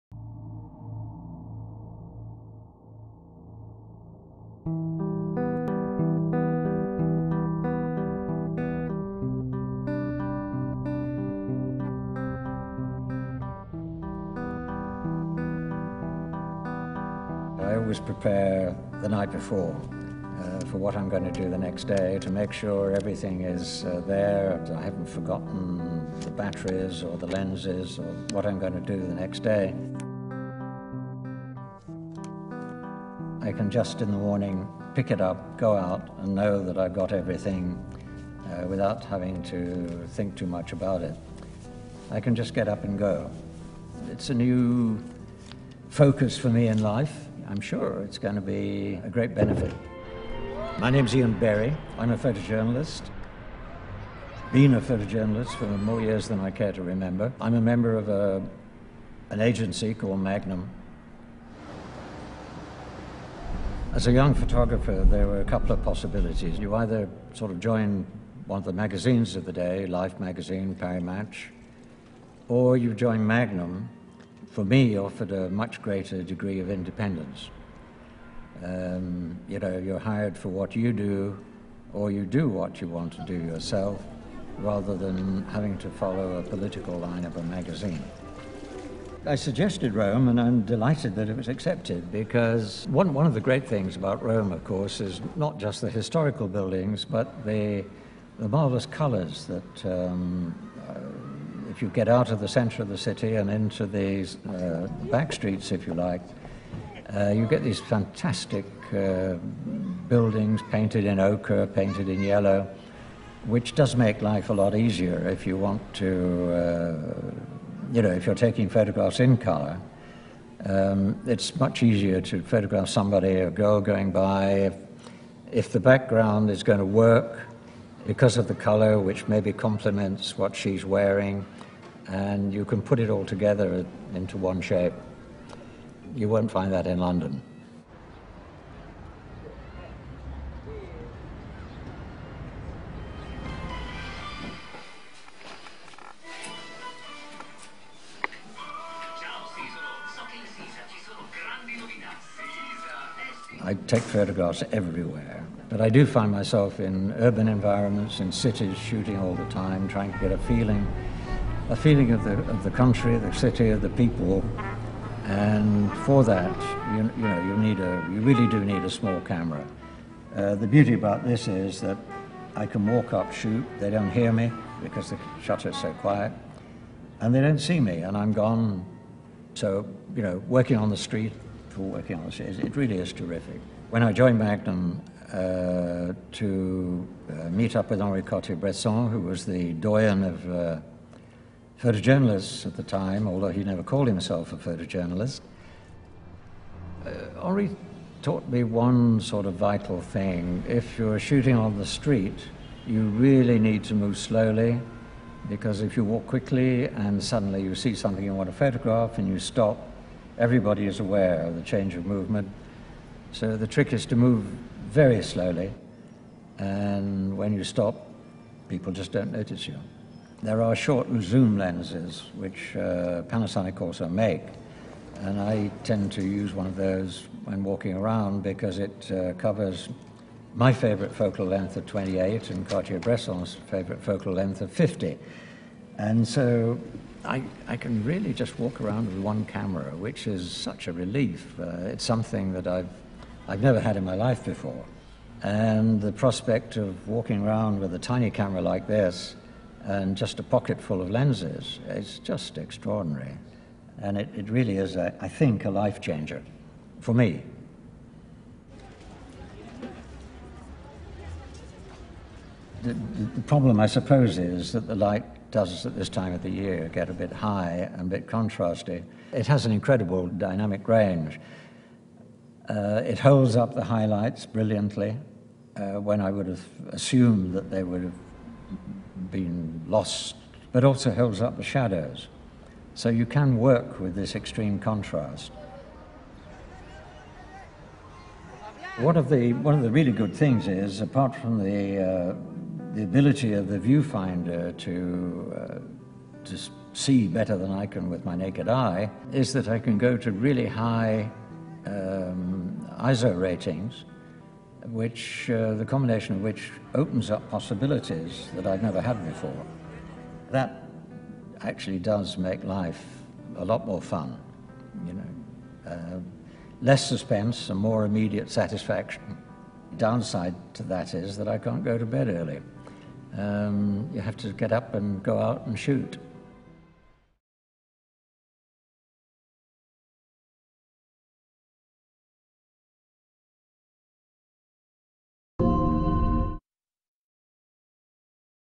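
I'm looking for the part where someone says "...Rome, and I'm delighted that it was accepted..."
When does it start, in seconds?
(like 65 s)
89 s.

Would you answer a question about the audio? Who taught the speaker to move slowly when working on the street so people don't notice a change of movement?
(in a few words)
Henri Cartier-Bresson.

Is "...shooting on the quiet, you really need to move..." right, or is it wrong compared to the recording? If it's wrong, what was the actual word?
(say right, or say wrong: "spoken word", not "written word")
wrong: "street", not "quiet".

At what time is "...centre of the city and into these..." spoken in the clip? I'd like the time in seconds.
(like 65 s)
102 s.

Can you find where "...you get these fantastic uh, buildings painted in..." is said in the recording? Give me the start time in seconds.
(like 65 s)
107 s.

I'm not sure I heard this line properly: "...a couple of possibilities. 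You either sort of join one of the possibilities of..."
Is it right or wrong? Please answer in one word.
wrong.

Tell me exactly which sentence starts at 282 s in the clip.
So you can work with this extreme contrast.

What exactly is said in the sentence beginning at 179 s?
So, you know, working on the street, for working on the street, it really is terrific.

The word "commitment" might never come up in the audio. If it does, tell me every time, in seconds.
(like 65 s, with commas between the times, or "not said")
not said.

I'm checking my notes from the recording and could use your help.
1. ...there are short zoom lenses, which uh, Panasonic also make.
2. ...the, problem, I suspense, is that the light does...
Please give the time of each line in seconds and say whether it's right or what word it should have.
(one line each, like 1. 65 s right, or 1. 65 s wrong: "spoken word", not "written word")
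1. 220 s right
2. 262 s wrong: "suppose", not "suspense".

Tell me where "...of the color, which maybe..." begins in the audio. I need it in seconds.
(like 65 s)
128 s.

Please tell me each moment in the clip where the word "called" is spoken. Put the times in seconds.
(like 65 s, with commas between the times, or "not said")
59 s, 193 s.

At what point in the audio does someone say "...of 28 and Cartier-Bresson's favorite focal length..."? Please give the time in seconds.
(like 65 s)
231 s.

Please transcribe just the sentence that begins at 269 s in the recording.
It has an incredible dynamic range.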